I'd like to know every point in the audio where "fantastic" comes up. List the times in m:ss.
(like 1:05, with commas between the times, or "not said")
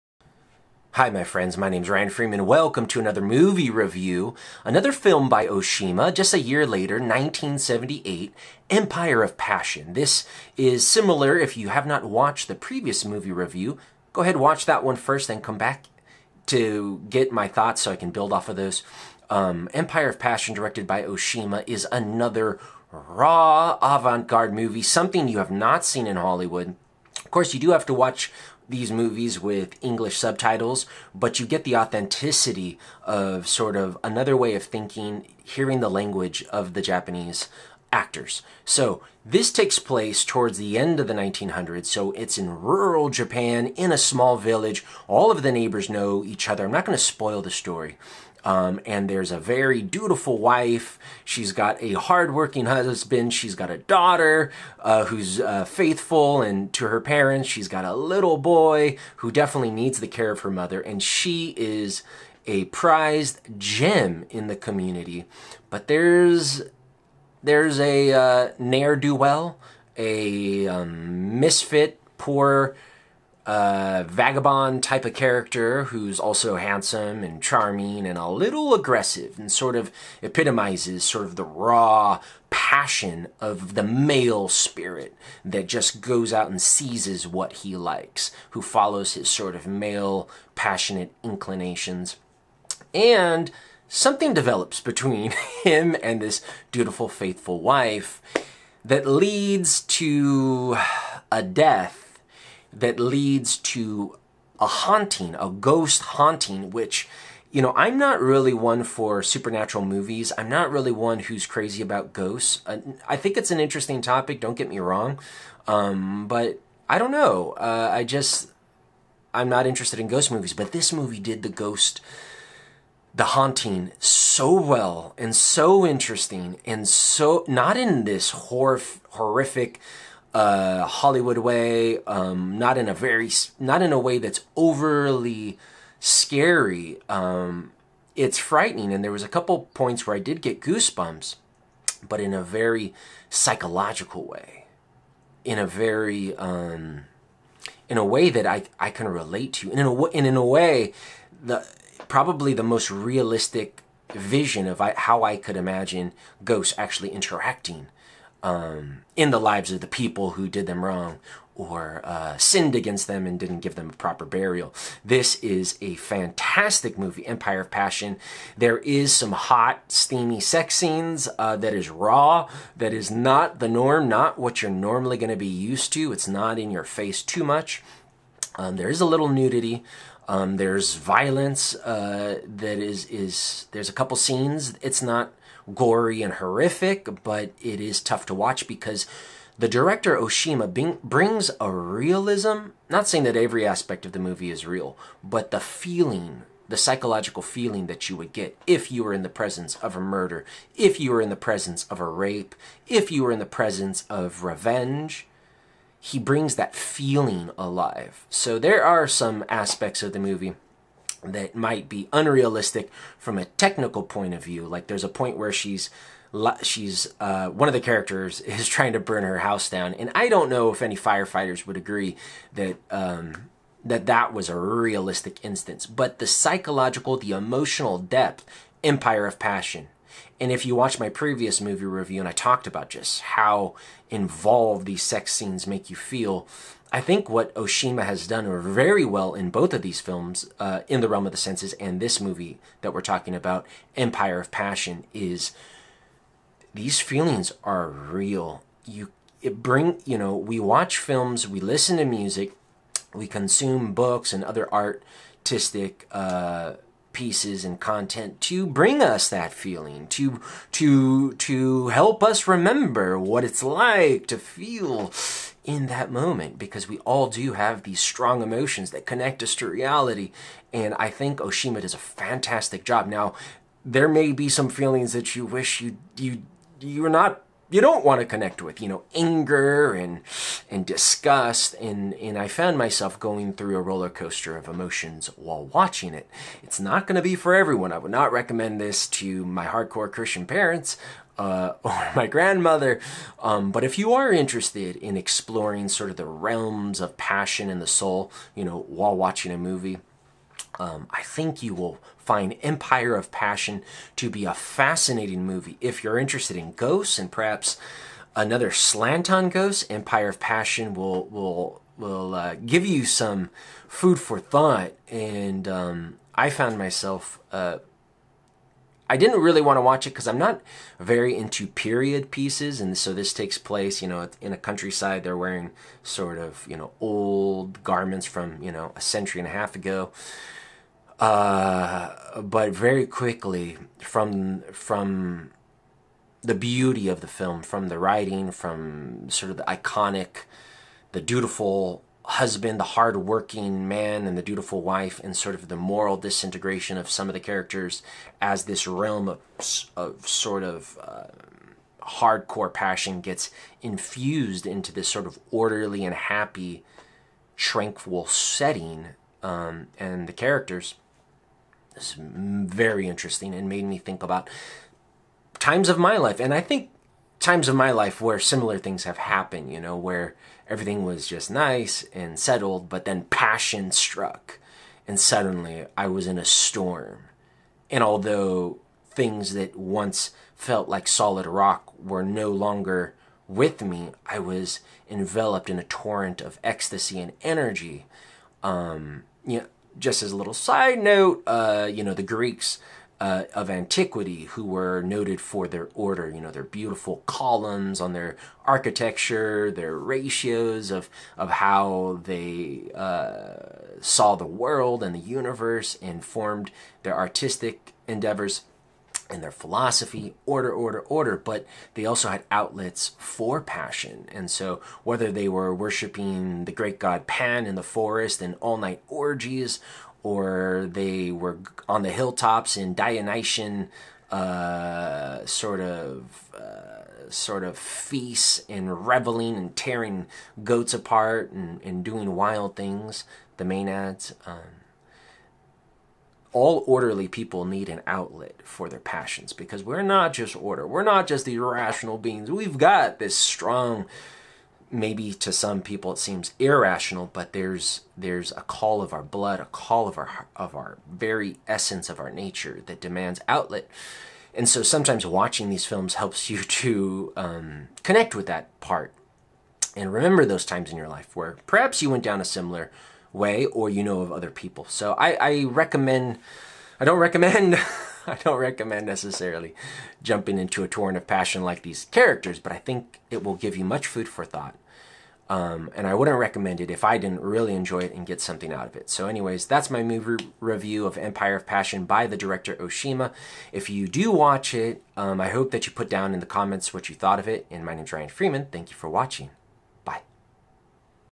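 2:45, 4:31.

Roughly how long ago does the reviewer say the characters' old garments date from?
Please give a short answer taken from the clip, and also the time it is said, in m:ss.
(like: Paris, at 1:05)
a century and a half, at 5:28.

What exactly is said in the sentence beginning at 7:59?
So, anyways, that's my movie review of Empire of Passion by the director Oshima.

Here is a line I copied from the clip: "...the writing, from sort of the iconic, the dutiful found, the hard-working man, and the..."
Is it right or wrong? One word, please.
wrong.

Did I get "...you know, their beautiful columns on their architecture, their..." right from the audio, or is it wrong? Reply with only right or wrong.
right.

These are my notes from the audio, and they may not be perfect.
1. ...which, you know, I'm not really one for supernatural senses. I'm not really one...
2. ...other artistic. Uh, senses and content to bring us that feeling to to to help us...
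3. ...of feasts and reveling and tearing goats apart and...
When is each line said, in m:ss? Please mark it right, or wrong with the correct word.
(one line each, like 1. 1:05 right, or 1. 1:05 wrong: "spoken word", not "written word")
1. 1:46 wrong: "movies", not "senses"
2. 4:14 wrong: "pieces", not "senses"
3. 7:07 right.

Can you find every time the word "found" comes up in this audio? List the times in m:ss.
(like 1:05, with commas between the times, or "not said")
4:42, 5:16.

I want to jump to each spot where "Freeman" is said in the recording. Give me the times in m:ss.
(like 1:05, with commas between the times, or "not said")
0:02, 8:08.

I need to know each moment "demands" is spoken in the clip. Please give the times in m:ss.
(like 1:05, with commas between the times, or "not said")
7:32.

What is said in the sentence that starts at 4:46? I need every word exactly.
It's not going to be for everyone.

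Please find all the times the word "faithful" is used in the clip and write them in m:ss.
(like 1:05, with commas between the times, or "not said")
0:55, 1:37.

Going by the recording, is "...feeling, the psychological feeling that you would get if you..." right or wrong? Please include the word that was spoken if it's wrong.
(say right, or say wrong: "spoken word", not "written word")
right.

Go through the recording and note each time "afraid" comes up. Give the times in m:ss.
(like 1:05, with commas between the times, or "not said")
not said.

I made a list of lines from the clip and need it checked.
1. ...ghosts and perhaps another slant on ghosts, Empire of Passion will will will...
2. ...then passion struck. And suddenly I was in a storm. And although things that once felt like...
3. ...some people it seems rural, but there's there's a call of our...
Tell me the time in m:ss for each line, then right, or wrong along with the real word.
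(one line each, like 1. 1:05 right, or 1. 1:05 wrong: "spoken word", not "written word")
1. 5:06 right
2. 6:13 right
3. 7:25 wrong: "irrational", not "rural".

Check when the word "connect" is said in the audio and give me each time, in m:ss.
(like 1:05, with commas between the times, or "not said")
4:29, 4:38, 7:38.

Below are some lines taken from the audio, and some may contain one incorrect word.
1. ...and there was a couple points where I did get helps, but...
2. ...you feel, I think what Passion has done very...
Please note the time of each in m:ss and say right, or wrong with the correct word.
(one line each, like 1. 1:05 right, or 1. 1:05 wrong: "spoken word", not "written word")
1. 2:18 wrong: "goosebumps", not "helps"
2. 3:55 wrong: "Oshima", not "Passion".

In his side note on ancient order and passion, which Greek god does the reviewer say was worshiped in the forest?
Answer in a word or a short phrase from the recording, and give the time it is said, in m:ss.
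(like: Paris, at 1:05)
Pan, at 6:56.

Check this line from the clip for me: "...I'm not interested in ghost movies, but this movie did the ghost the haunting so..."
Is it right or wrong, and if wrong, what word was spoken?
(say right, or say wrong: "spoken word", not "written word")
right.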